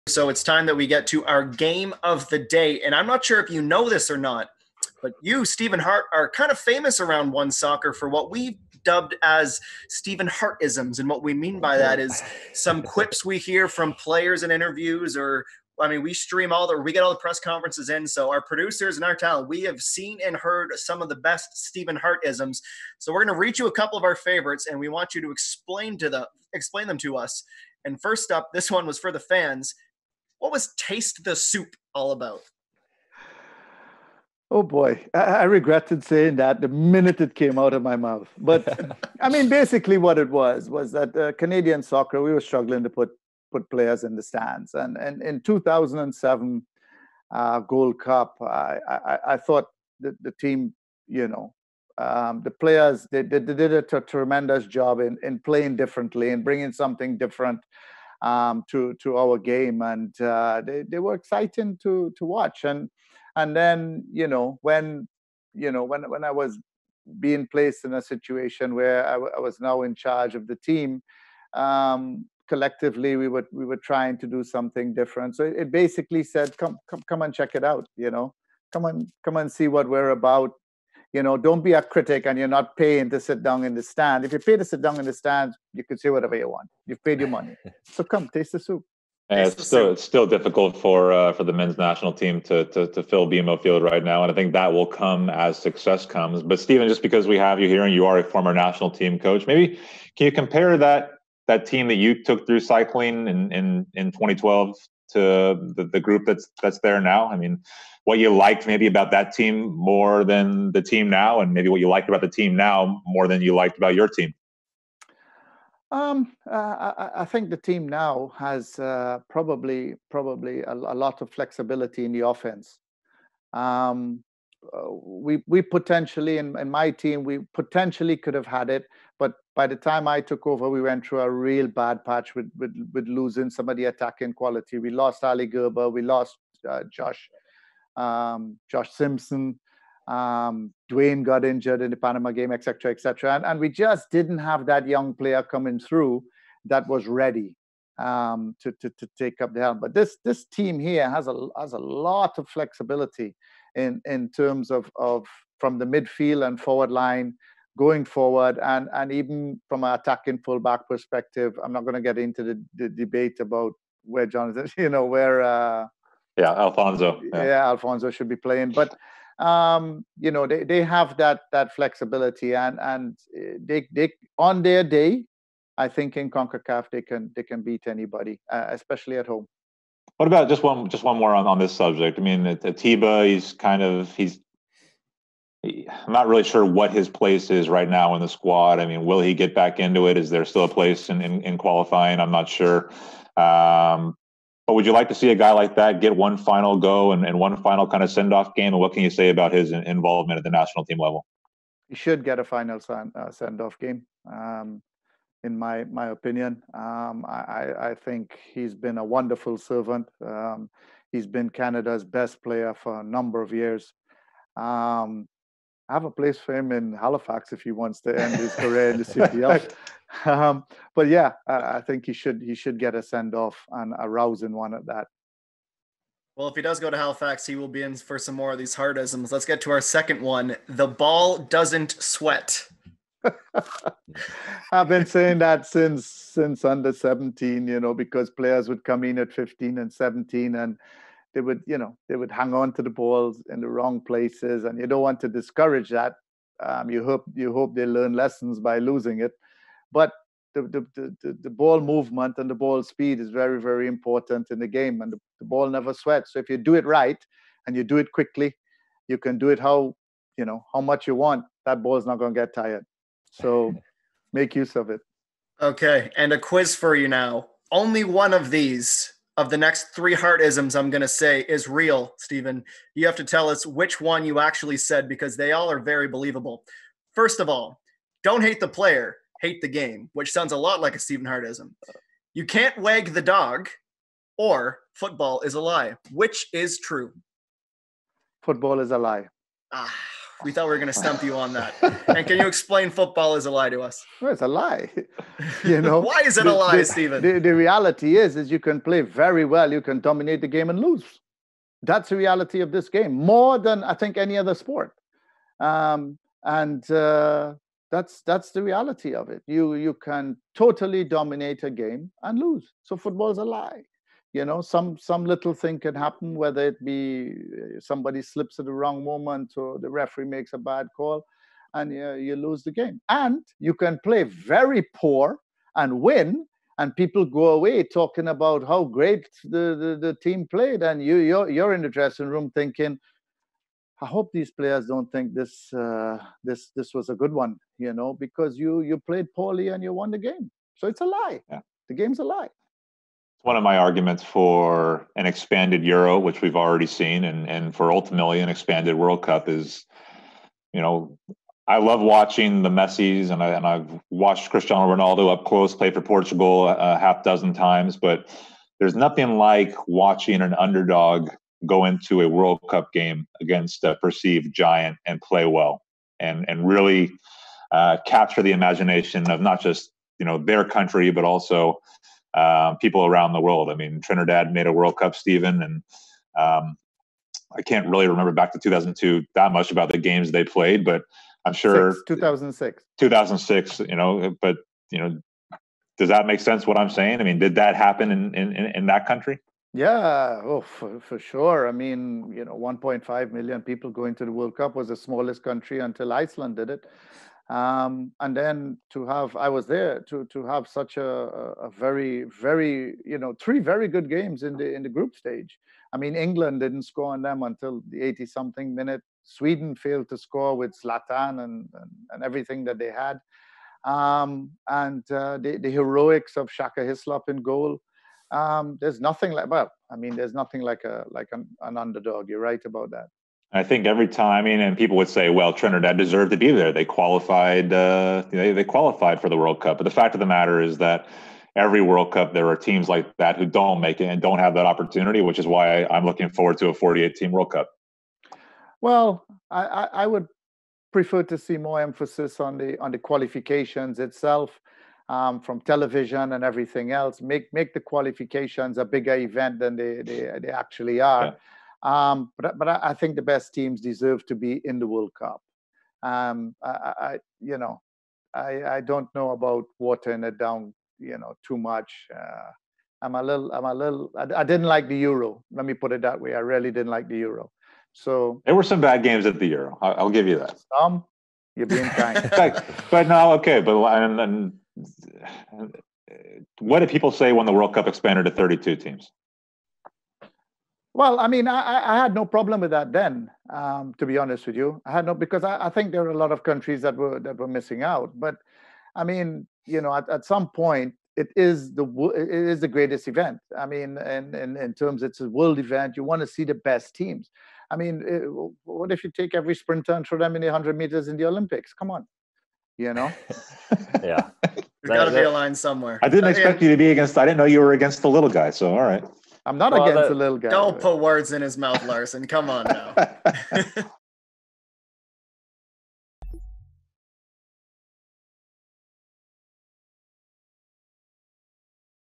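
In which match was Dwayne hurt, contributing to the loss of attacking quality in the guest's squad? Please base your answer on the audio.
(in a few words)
Panama game.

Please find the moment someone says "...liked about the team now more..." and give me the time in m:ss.
1:51.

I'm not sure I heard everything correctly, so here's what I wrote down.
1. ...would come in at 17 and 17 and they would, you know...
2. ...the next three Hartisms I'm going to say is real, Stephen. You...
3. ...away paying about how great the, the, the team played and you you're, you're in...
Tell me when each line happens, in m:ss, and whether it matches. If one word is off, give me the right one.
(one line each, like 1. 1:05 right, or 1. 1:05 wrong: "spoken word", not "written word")
1. 3:58 wrong: "15", not "17"
2. 4:29 right
3. 5:27 wrong: "talking", not "paying".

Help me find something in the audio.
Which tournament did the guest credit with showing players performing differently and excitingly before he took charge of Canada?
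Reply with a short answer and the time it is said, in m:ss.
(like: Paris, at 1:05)
2007 Gold Cup, at 0:45.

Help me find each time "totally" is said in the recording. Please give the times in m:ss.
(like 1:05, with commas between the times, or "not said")
5:10.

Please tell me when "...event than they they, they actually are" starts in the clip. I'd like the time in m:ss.
7:29.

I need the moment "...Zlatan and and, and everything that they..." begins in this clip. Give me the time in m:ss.
6:50.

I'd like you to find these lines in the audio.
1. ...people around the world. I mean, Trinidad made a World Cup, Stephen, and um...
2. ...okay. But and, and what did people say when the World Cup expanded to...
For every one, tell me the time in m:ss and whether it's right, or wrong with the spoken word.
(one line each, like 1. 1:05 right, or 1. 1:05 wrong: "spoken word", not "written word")
1. 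6:12 right
2. 7:53 right.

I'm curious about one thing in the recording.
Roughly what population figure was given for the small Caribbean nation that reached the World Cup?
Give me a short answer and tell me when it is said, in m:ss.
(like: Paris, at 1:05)
1.5 million, at 6:32.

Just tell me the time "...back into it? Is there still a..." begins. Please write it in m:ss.
3:09.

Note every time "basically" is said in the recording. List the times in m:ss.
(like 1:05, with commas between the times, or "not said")
0:39, 1:15.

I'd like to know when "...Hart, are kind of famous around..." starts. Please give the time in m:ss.
0:05.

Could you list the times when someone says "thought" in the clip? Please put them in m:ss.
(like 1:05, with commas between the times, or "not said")
0:49, 4:50.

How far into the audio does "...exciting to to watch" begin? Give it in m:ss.
1:01.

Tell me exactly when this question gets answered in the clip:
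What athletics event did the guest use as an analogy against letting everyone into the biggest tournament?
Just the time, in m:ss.
8:20.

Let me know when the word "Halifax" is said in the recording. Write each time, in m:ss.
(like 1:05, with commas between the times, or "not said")
3:36, 3:46.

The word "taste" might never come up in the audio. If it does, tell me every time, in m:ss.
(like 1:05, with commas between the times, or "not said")
0:30, 1:28.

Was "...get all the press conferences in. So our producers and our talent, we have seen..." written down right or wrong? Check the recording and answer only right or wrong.
right.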